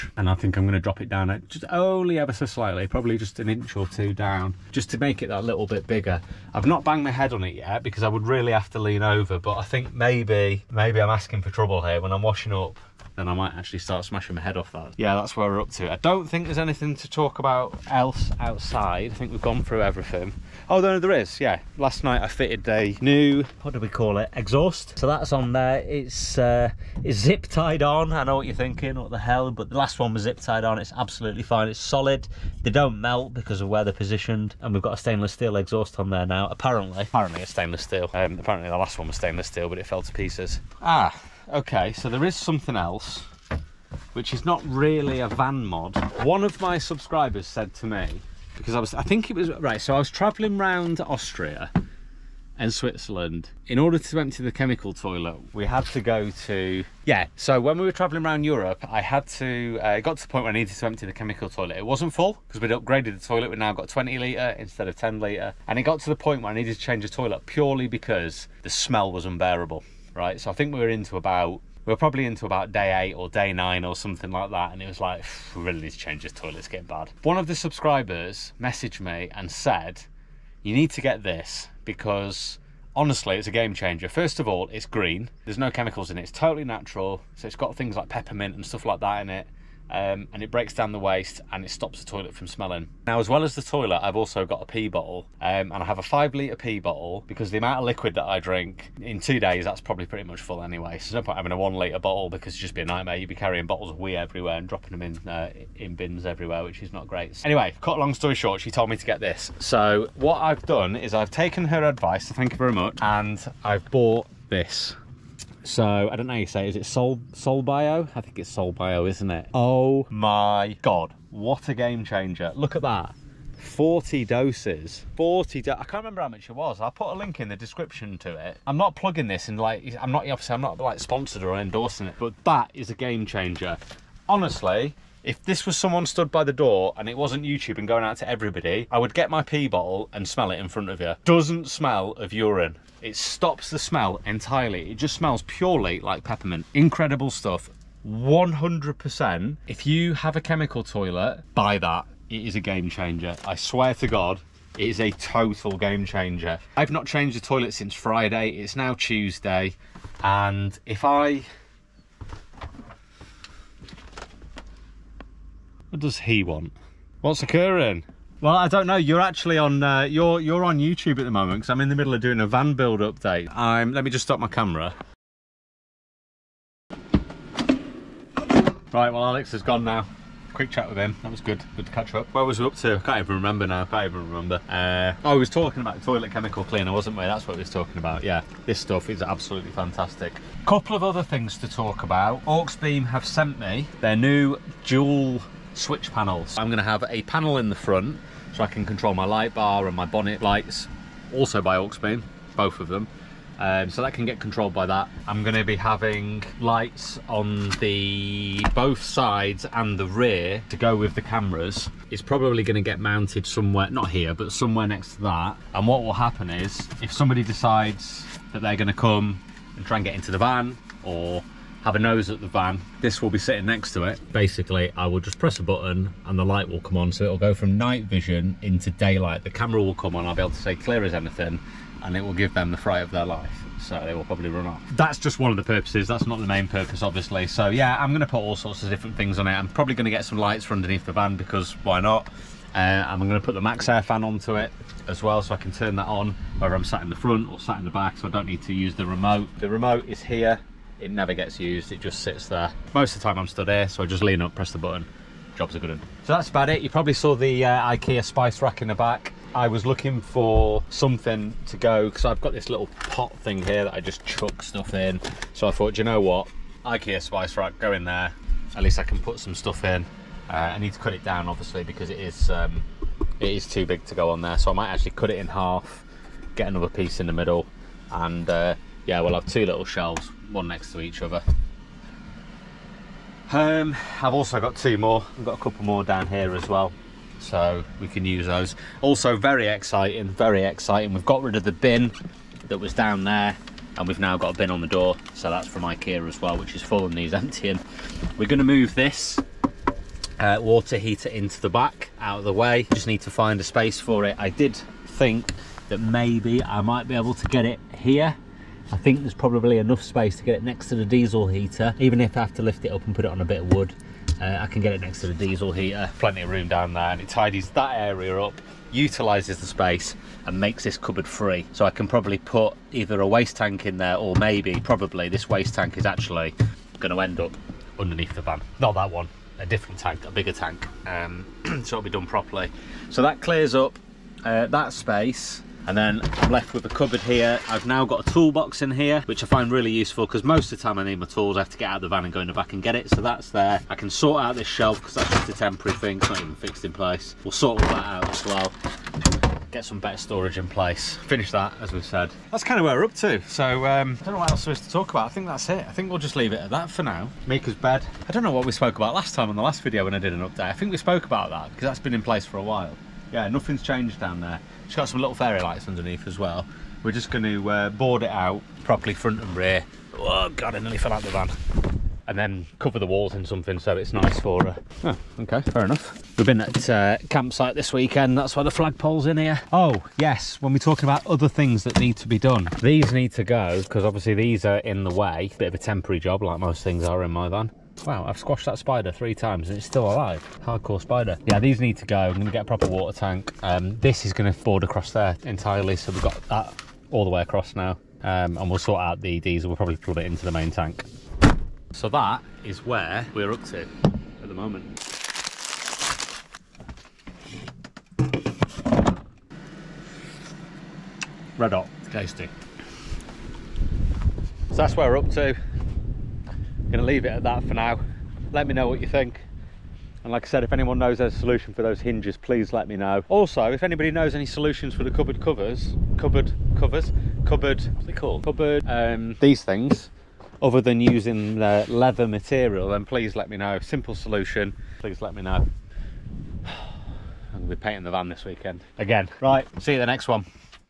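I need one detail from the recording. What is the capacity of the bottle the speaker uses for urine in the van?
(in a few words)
5 litres.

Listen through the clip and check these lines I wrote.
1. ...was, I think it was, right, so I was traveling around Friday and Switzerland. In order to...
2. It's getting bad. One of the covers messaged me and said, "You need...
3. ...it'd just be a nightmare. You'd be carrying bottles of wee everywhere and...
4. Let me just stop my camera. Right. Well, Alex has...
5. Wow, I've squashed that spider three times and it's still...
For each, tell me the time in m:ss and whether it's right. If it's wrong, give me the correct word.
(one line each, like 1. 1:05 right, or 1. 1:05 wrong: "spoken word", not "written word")
1. 0:48 wrong: "Austria", not "Friday"
2. 1:16 wrong: "subscribers", not "covers"
3. 1:42 right
4. 2:53 right
5. 6:28 right.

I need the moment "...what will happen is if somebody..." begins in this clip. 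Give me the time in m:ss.
3:35.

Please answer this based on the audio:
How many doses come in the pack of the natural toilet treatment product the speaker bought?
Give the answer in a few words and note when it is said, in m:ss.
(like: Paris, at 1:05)
40, at 2:03.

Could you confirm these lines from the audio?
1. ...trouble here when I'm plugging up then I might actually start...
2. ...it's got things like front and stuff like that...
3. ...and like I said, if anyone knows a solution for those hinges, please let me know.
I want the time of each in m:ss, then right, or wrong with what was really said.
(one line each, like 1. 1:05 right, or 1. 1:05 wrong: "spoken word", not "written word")
1. 0:11 wrong: "washing", not "plugging"
2. 1:27 wrong: "peppermint", not "front"
3. 7:00 right.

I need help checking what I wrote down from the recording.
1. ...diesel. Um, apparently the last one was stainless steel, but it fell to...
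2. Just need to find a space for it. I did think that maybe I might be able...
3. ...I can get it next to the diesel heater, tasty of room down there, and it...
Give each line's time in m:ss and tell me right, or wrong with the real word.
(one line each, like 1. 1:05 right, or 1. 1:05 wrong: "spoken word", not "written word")
1. 0:37 wrong: "steel", not "diesel"
2. 5:02 right
3. 5:14 wrong: "plenty", not "tasty".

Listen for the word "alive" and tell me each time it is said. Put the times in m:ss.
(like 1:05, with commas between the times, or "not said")
6:30.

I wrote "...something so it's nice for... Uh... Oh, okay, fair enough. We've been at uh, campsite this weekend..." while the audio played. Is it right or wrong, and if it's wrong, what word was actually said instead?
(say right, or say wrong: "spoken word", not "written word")
right.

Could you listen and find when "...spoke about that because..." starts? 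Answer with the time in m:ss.
6:00.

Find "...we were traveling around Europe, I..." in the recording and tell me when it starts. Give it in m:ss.
0:57.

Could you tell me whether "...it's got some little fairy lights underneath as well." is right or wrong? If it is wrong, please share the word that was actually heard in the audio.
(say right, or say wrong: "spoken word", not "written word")
right.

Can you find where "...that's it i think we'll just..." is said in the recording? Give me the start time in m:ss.
5:55.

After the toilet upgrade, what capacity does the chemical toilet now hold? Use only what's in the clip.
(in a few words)
20 litres.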